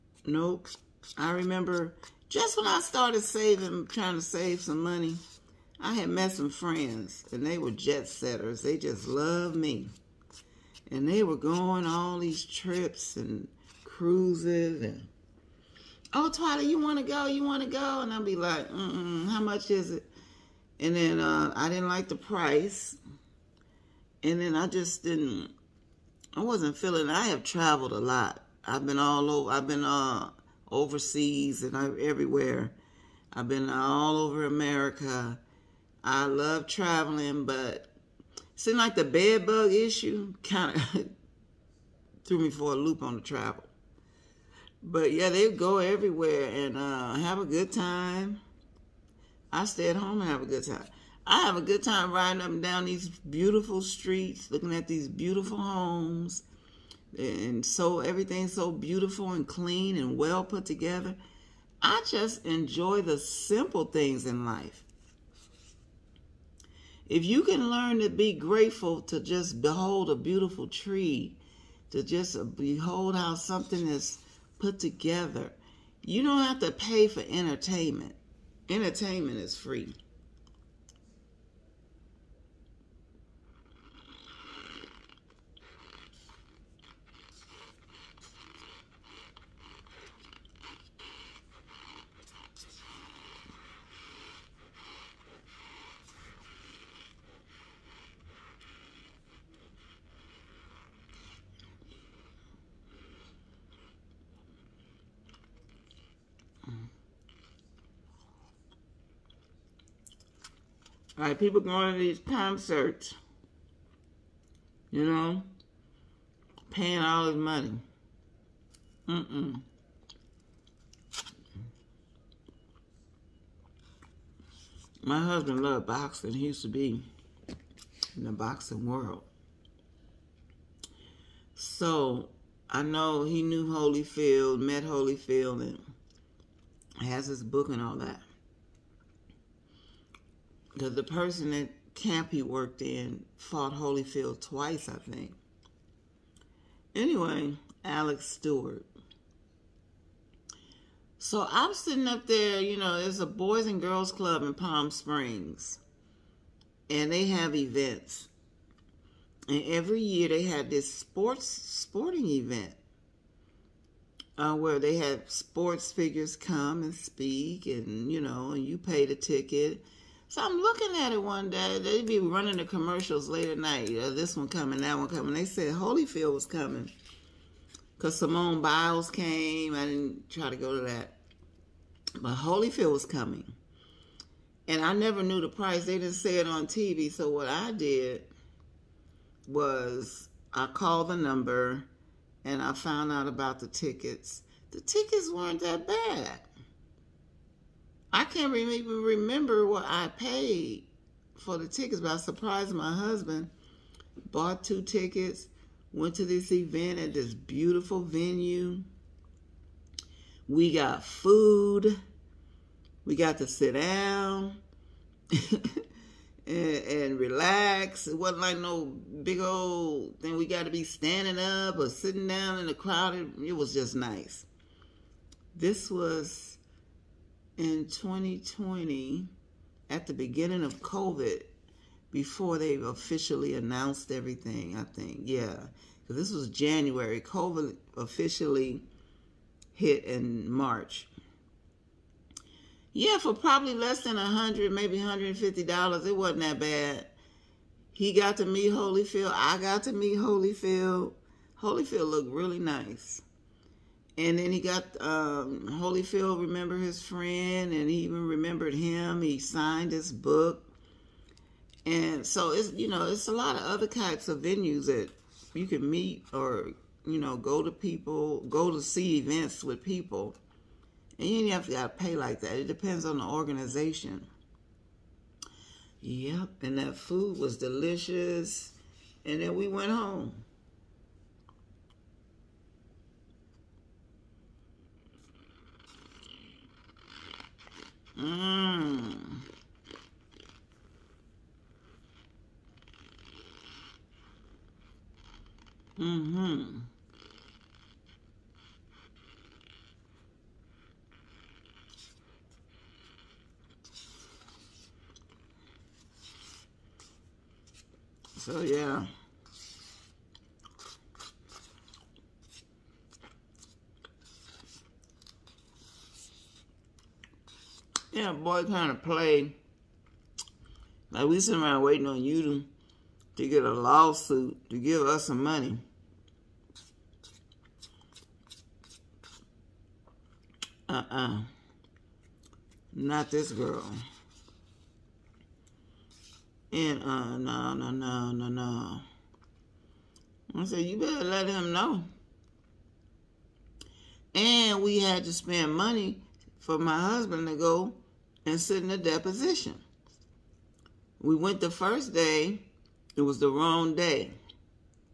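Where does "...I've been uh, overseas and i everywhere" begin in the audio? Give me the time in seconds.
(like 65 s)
29 s.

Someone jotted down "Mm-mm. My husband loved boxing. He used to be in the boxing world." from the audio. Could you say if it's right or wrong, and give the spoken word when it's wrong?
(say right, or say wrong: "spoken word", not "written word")
right.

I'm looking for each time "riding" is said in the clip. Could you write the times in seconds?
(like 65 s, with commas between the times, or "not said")
52 s.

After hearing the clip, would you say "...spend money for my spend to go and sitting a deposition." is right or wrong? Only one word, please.
wrong.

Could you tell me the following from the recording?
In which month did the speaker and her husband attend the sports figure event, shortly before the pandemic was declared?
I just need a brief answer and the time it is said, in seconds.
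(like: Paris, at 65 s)
January, at 236 s.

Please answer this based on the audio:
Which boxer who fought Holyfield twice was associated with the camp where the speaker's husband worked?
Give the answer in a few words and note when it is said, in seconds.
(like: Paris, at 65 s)
Alex Stewart, at 147 s.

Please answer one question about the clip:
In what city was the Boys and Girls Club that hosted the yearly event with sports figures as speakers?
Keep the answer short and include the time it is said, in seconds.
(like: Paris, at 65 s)
Palm Springs, at 154 s.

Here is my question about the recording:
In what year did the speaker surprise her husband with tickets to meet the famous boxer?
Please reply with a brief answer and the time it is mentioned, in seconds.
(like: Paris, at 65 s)
2020, at 227 s.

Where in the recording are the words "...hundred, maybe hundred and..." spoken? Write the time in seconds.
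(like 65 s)
244 s.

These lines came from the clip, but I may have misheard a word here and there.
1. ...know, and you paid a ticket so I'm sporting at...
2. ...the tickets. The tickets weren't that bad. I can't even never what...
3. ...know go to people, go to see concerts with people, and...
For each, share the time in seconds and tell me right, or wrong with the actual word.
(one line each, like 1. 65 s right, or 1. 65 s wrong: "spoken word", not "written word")
1. 168 s wrong: "looking", not "sporting"
2. 193 s wrong: "remember", not "never"
3. 267 s wrong: "events", not "concerts".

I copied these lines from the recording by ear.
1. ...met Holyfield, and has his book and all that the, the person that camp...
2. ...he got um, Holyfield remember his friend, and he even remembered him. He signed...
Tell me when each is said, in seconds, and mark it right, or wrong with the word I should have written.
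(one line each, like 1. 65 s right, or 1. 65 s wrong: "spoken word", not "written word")
1. 134 s right
2. 254 s right.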